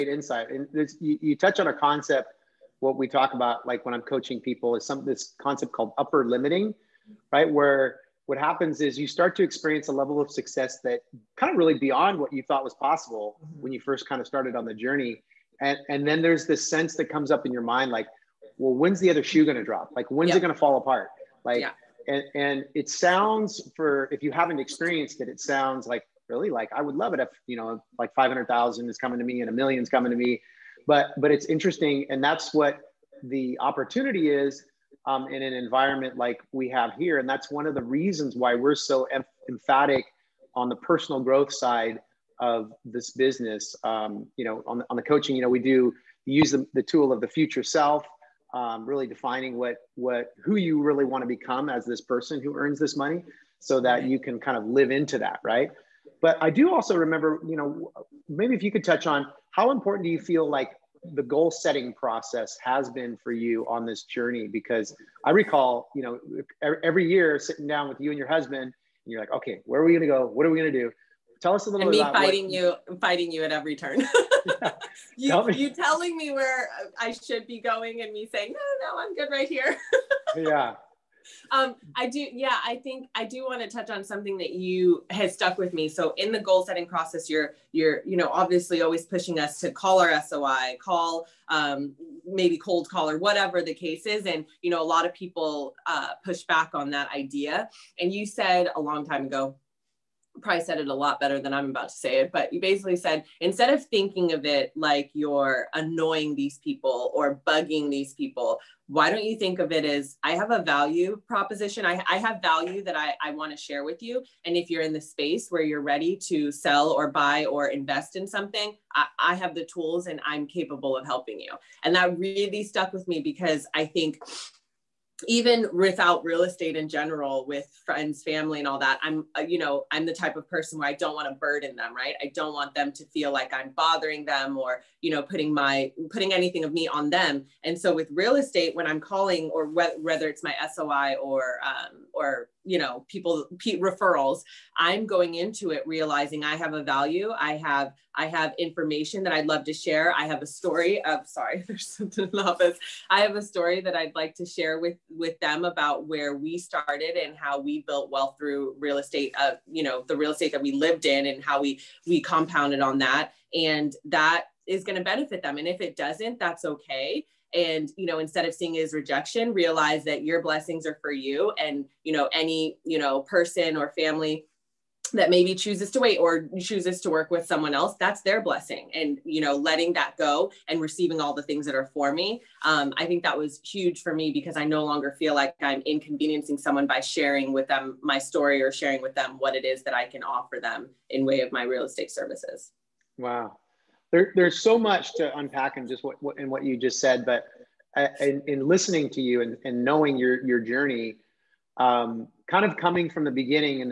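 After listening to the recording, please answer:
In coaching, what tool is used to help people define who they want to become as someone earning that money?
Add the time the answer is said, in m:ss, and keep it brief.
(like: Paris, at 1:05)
the future self, at 0:47.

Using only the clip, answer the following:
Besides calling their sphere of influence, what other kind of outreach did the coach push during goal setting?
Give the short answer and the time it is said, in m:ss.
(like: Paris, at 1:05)
cold call, at 1:32.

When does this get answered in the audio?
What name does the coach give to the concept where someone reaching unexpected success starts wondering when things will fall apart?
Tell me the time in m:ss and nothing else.
0:05.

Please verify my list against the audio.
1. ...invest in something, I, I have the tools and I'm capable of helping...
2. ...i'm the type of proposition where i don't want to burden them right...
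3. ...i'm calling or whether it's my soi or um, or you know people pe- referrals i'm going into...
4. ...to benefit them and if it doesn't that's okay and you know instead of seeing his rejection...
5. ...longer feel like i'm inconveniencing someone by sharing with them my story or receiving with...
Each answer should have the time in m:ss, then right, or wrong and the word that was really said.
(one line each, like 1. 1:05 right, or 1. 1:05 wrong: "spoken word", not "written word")
1. 1:57 right
2. 2:09 wrong: "person", not "proposition"
3. 2:18 right
4. 2:44 right
5. 3:04 wrong: "sharing", not "receiving".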